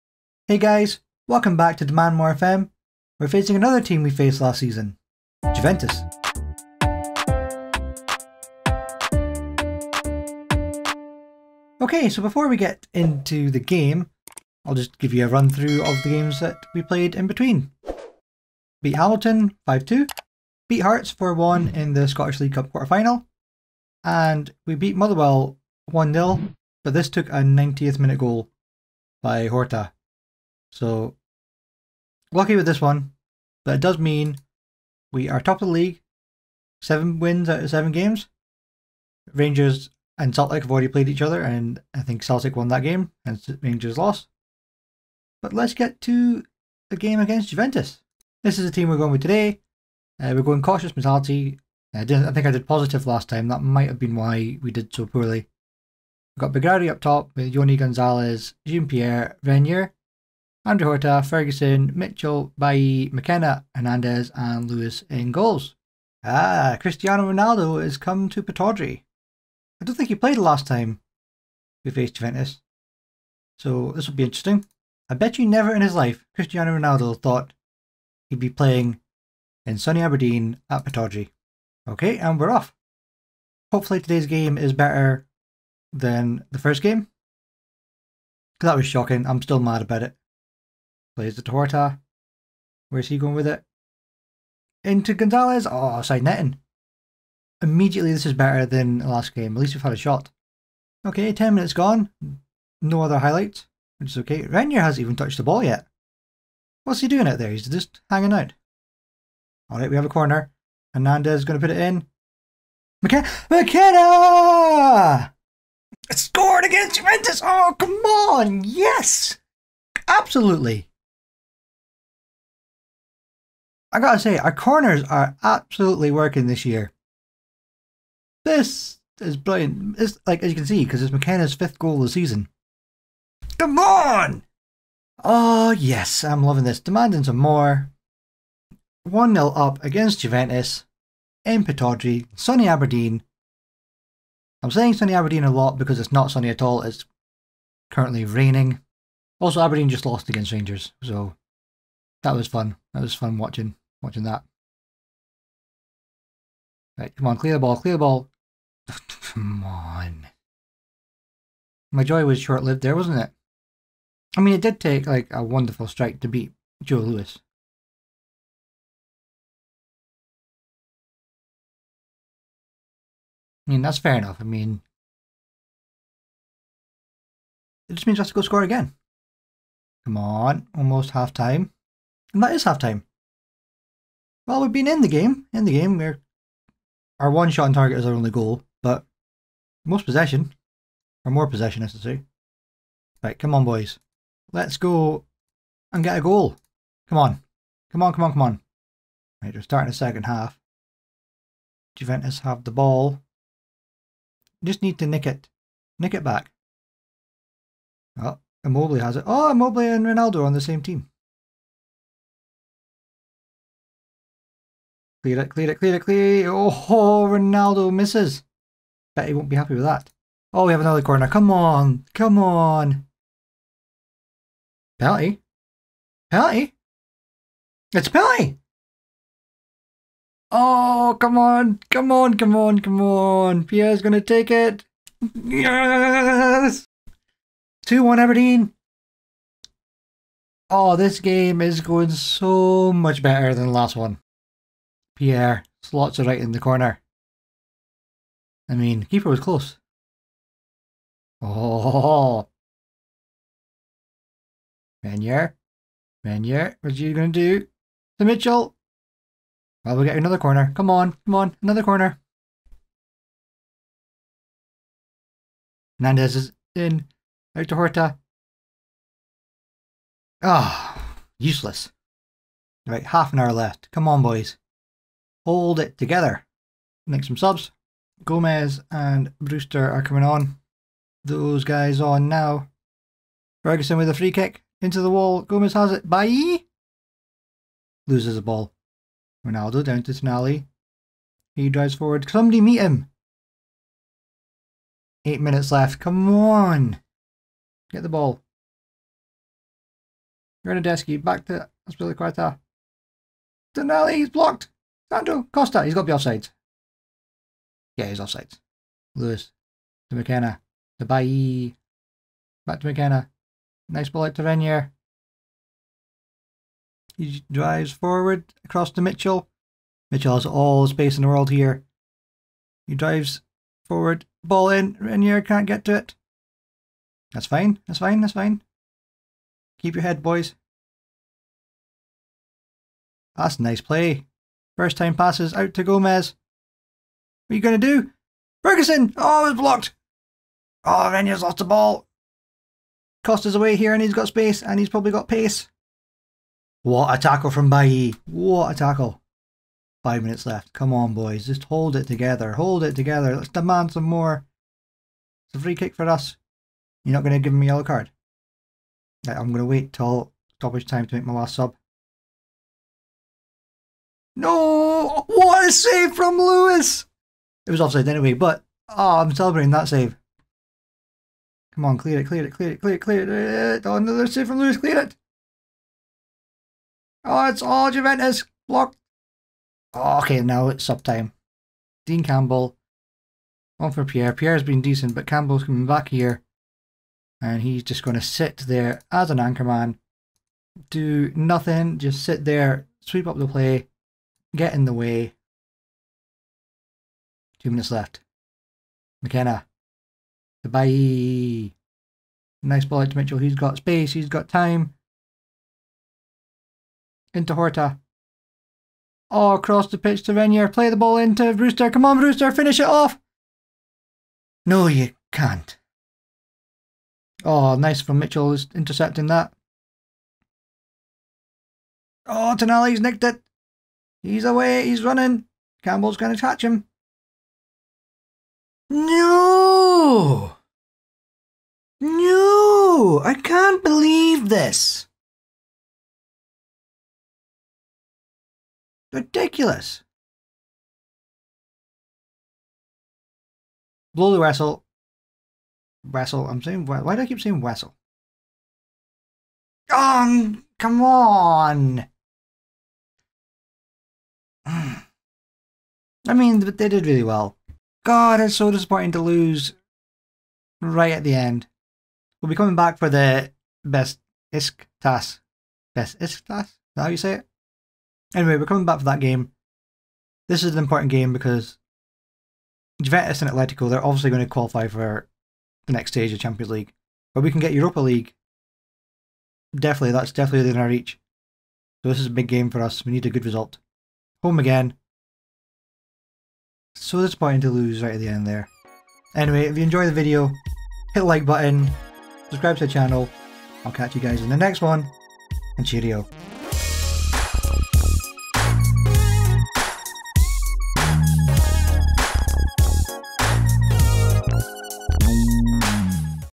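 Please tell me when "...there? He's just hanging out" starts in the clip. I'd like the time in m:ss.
1:47.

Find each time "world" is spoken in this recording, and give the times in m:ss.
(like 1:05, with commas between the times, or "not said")
5:21.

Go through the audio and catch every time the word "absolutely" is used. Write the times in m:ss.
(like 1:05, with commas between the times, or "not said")
2:00, 2:05.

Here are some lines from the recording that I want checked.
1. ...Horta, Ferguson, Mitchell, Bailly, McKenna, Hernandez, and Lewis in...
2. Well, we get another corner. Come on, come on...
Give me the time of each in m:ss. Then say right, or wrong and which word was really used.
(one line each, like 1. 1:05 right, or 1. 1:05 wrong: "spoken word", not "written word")
1. 1:00 right
2. 4:19 right.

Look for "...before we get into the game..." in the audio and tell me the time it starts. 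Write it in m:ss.
0:12.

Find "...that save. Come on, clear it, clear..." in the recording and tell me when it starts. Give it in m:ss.
6:09.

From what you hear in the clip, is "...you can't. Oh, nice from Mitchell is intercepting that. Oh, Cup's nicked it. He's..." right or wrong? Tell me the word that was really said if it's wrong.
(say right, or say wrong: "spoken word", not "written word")
wrong: "Tonali", not "Cup".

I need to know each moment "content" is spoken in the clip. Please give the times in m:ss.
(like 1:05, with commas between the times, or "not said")
not said.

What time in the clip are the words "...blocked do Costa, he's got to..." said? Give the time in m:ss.
5:04.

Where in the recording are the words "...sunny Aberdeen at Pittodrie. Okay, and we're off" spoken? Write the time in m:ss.
1:19.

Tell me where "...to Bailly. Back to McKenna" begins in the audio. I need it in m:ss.
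5:10.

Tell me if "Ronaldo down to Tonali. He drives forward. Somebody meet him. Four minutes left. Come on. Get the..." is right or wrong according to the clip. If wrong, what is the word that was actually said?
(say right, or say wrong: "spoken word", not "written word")
wrong: "Eight", not "Four".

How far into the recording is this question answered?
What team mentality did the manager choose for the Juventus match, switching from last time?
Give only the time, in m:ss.
0:50.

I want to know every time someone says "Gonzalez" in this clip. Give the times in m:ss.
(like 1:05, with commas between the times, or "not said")
0:57, 1:35.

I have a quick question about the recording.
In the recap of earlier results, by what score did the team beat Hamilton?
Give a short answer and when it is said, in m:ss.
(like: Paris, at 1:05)
5-2, at 0:19.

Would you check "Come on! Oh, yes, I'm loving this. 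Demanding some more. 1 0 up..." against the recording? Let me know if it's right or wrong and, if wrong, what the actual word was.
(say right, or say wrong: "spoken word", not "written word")
right.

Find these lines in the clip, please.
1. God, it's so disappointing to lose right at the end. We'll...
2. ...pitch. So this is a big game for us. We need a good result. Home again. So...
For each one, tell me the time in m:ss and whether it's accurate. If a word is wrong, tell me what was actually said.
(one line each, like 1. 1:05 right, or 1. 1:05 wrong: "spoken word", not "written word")
1. 7:38 right
2. 8:00 wrong: "reach", not "pitch".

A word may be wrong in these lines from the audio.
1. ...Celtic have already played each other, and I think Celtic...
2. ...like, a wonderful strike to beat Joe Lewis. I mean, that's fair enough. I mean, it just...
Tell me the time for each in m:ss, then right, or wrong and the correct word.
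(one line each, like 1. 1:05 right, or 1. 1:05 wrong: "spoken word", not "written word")
1. 0:40 right
2. 2:45 right.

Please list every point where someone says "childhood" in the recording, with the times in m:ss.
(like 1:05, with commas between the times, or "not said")
not said.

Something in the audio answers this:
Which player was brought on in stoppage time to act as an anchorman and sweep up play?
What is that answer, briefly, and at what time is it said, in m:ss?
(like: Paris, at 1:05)
Dean Campbell, at 6:22.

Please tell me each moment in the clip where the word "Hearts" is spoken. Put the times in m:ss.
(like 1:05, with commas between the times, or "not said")
0:20.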